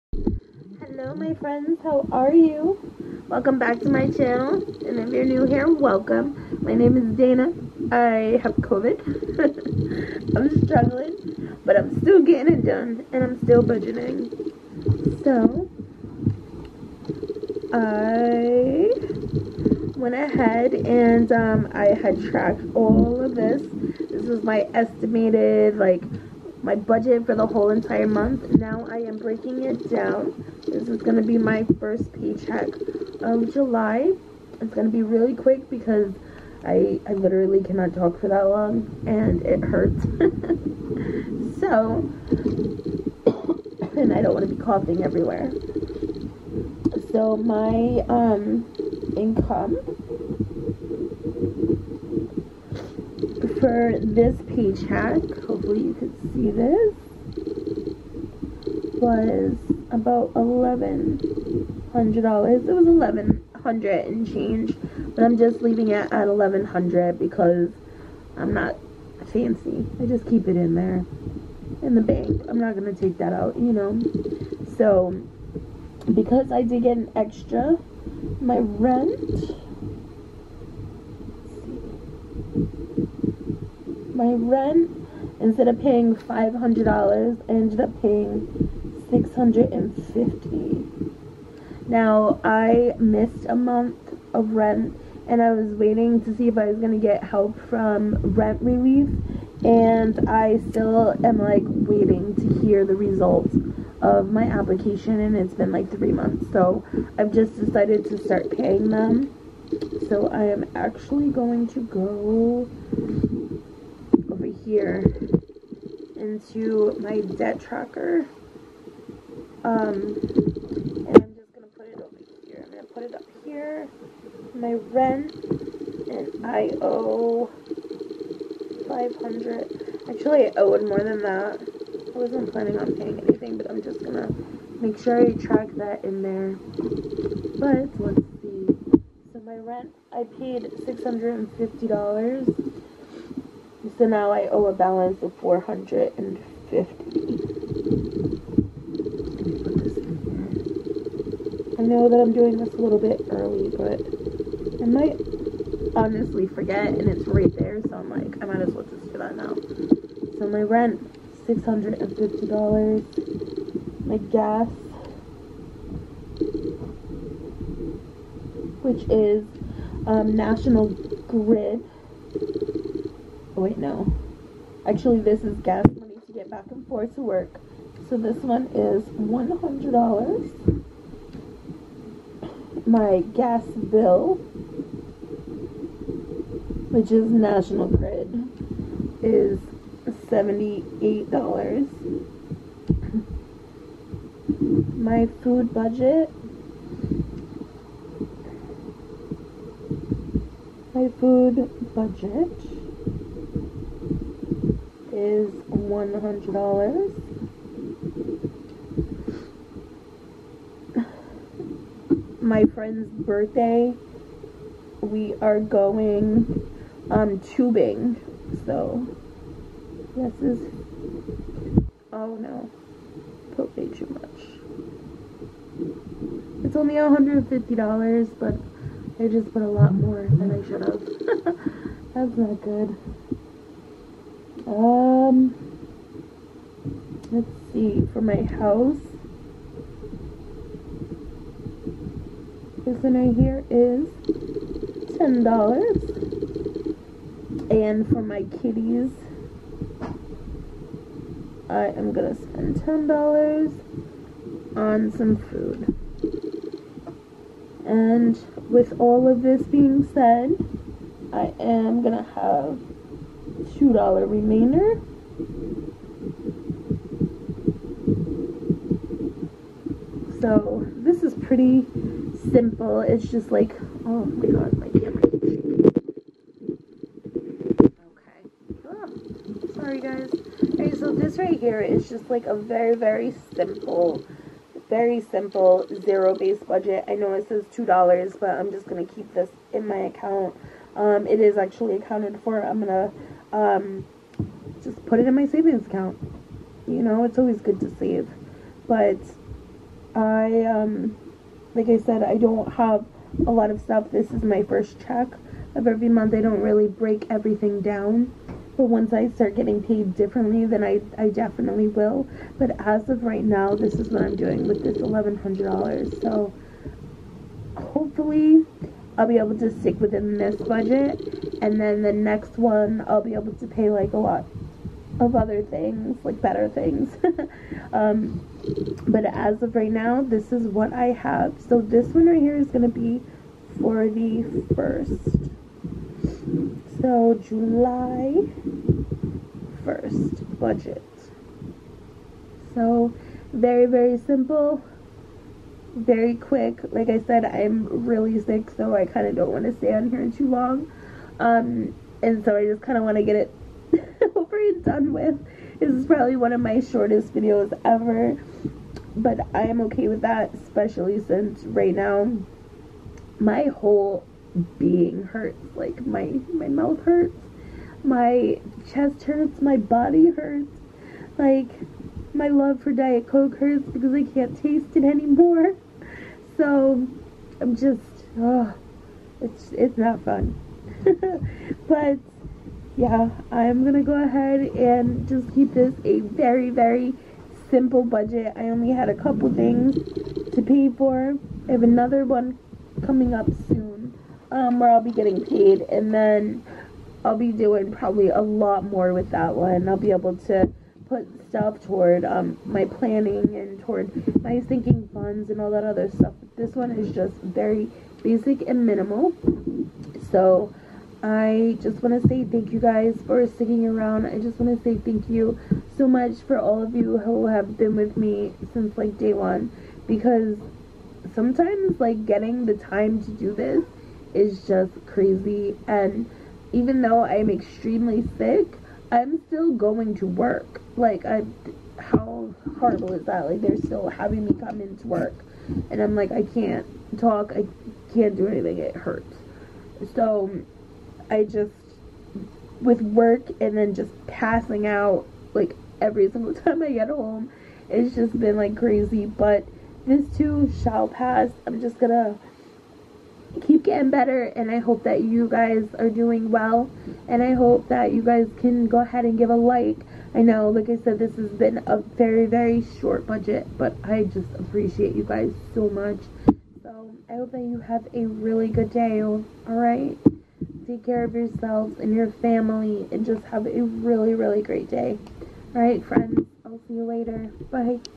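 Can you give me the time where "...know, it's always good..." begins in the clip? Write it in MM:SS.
04:57.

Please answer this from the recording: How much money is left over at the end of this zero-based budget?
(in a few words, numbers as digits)
$2.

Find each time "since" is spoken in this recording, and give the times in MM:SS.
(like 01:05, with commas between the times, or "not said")
06:01, 06:58.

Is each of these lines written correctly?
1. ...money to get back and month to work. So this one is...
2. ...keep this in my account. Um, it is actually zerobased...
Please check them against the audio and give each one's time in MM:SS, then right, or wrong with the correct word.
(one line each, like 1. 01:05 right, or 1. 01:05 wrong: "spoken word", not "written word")
1. 02:55 wrong: "forth", not "month"
2. 04:49 wrong: "accounted", not "zerobased".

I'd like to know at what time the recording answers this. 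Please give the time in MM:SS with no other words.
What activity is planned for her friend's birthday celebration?
03:37.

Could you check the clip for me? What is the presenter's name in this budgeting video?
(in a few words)
Dana.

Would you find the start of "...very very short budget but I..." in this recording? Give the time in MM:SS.
07:41.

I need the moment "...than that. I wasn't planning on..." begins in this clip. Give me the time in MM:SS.
02:11.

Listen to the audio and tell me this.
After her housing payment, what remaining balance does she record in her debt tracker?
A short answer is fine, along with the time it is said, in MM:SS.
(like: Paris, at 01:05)
$450, at 02:25.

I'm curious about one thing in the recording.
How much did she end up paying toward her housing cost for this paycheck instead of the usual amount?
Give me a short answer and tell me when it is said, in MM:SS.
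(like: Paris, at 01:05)
$650, at 01:29.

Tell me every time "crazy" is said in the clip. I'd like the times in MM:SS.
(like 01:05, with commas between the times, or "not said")
07:05, 07:28.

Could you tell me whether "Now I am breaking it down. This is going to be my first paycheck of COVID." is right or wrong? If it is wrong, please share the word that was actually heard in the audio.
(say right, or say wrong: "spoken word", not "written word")
wrong: "July", not "COVID".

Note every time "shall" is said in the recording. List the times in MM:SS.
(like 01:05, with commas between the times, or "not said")
07:30.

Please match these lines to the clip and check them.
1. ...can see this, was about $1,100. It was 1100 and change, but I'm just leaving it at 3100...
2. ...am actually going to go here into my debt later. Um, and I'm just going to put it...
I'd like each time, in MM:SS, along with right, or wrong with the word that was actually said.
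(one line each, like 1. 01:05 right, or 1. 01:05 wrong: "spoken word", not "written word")
1. 00:55 wrong: "1100", not "3100"
2. 01:50 wrong: "tracker", not "later".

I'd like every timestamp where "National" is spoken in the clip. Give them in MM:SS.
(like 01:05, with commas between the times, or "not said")
02:50, 03:07.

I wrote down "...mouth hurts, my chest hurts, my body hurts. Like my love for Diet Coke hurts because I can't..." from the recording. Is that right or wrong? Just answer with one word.
right.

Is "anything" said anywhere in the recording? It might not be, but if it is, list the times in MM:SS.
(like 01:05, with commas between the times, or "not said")
02:13, 07:18.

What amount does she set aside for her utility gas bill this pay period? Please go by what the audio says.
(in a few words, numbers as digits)
$78.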